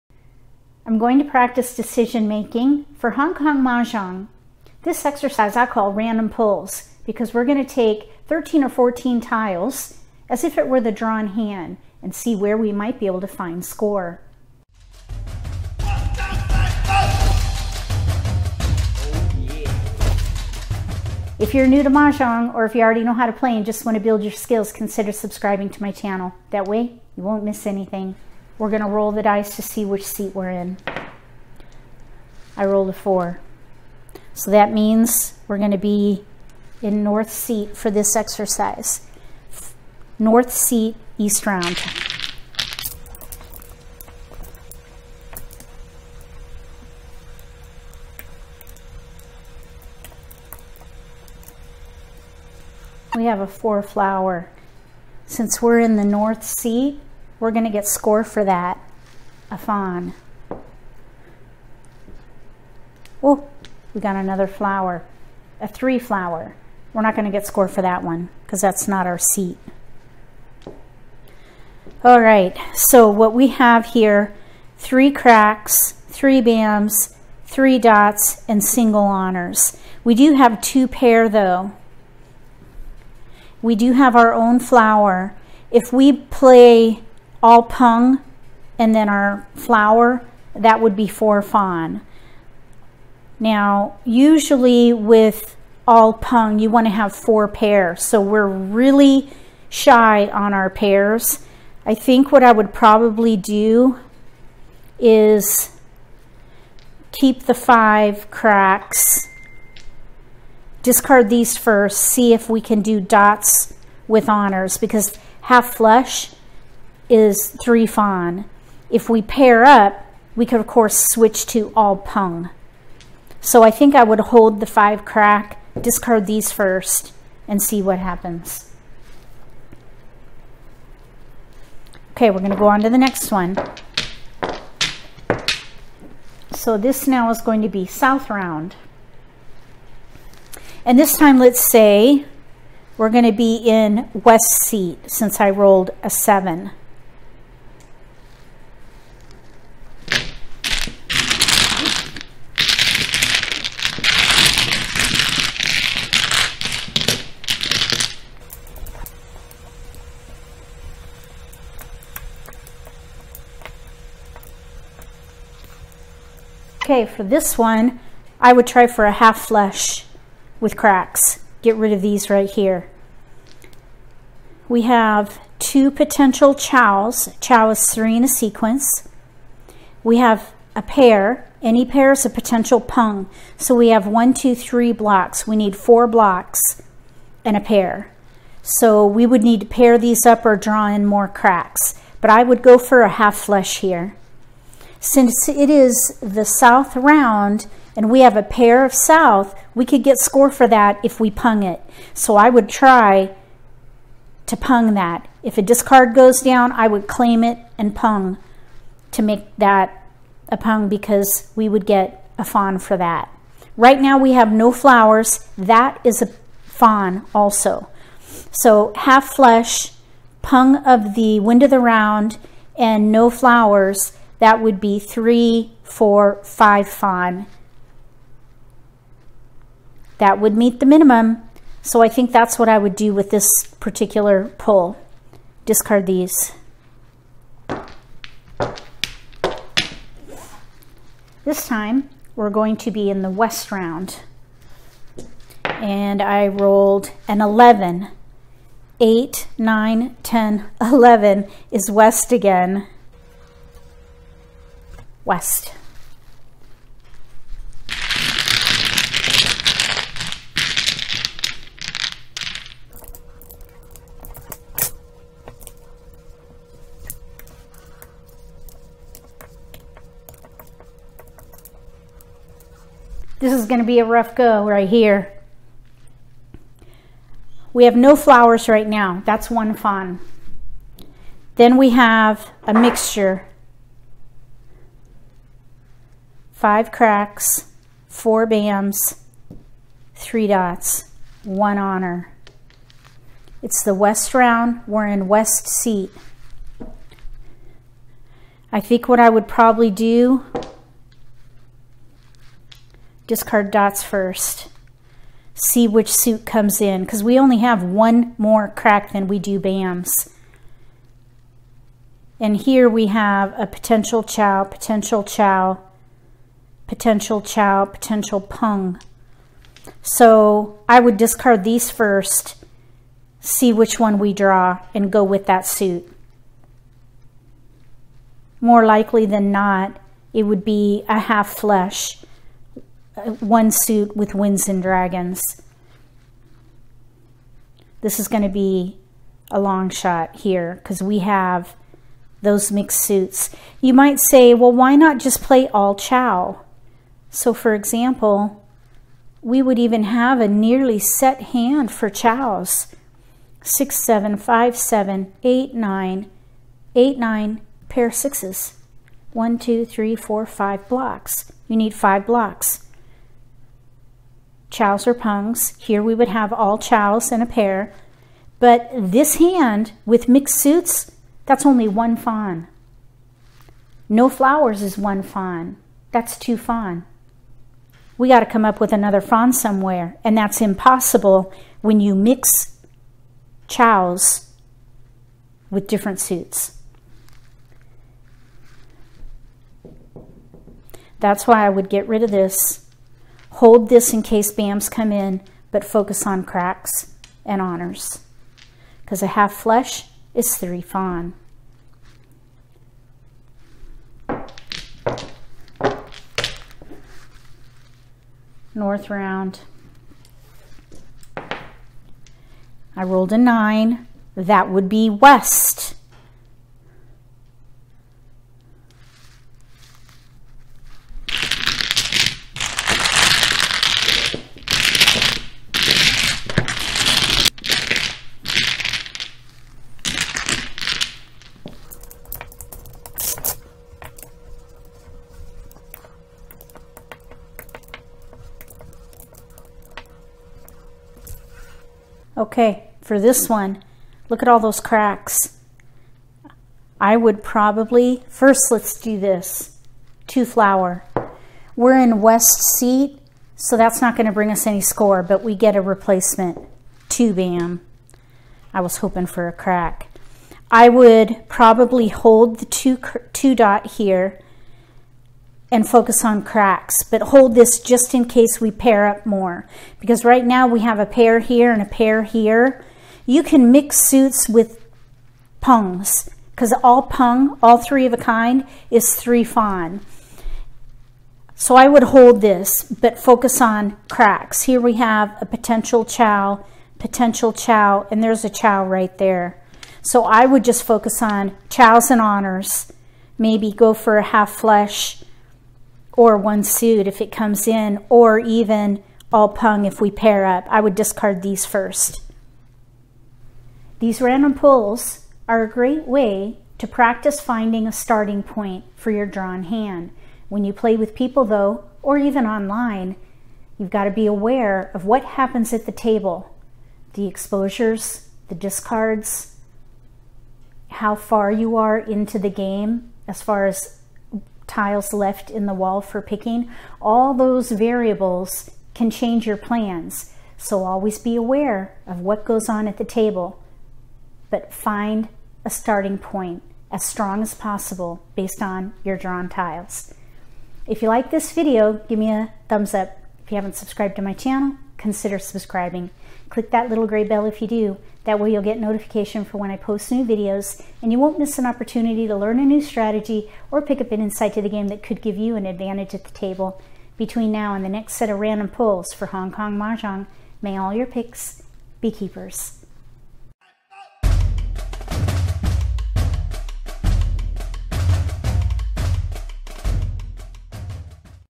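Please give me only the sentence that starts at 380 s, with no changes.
And that's impossible when you mix chows with different suits.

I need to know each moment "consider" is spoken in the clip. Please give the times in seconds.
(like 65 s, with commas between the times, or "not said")
24 s, 544 s.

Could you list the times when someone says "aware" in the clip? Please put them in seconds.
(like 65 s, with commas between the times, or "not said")
514 s, 531 s.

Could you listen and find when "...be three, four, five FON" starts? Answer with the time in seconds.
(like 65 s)
224 s.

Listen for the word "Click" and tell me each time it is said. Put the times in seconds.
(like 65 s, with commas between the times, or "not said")
546 s.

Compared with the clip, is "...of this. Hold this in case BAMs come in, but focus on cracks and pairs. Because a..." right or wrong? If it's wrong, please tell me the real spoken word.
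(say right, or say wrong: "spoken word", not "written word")
wrong: "honors", not "pairs".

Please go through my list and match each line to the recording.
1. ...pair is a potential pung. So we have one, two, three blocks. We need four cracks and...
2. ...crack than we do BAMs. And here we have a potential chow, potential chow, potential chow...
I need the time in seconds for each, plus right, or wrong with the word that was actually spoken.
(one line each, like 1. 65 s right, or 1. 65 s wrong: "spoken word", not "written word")
1. 181 s wrong: "blocks", not "cracks"
2. 308 s right.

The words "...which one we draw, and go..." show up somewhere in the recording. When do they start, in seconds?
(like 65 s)
323 s.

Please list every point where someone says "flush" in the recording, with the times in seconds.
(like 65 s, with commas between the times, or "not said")
115 s, 169 s, 193 s, 219 s, 331 s, 399 s, 494 s.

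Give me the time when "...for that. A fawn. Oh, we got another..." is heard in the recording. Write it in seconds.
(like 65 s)
58 s.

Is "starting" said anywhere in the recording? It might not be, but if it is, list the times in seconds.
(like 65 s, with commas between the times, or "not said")
507 s, 535 s.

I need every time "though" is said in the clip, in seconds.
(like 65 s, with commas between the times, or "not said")
81 s, 511 s.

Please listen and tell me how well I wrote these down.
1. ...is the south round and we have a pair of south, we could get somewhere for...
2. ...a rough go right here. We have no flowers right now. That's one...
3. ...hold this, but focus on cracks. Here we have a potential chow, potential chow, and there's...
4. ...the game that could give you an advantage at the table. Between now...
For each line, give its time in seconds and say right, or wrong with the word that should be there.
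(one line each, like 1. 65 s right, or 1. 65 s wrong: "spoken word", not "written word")
1. 195 s wrong: "score", not "somewhere"
2. 273 s right
3. 482 s right
4. 554 s right.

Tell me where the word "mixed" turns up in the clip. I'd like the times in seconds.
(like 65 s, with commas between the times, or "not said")
342 s, 370 s.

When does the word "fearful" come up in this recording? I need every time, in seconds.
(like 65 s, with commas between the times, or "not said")
not said.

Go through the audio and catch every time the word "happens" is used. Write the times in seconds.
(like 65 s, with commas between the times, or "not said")
127 s, 515 s.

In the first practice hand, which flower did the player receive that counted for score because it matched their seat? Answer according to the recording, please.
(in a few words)
4 flower.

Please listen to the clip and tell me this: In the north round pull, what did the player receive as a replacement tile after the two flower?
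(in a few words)
2 bam.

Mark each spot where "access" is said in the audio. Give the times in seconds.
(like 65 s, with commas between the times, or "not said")
not said.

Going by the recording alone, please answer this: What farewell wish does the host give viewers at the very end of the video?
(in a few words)
May all your picks be keepers.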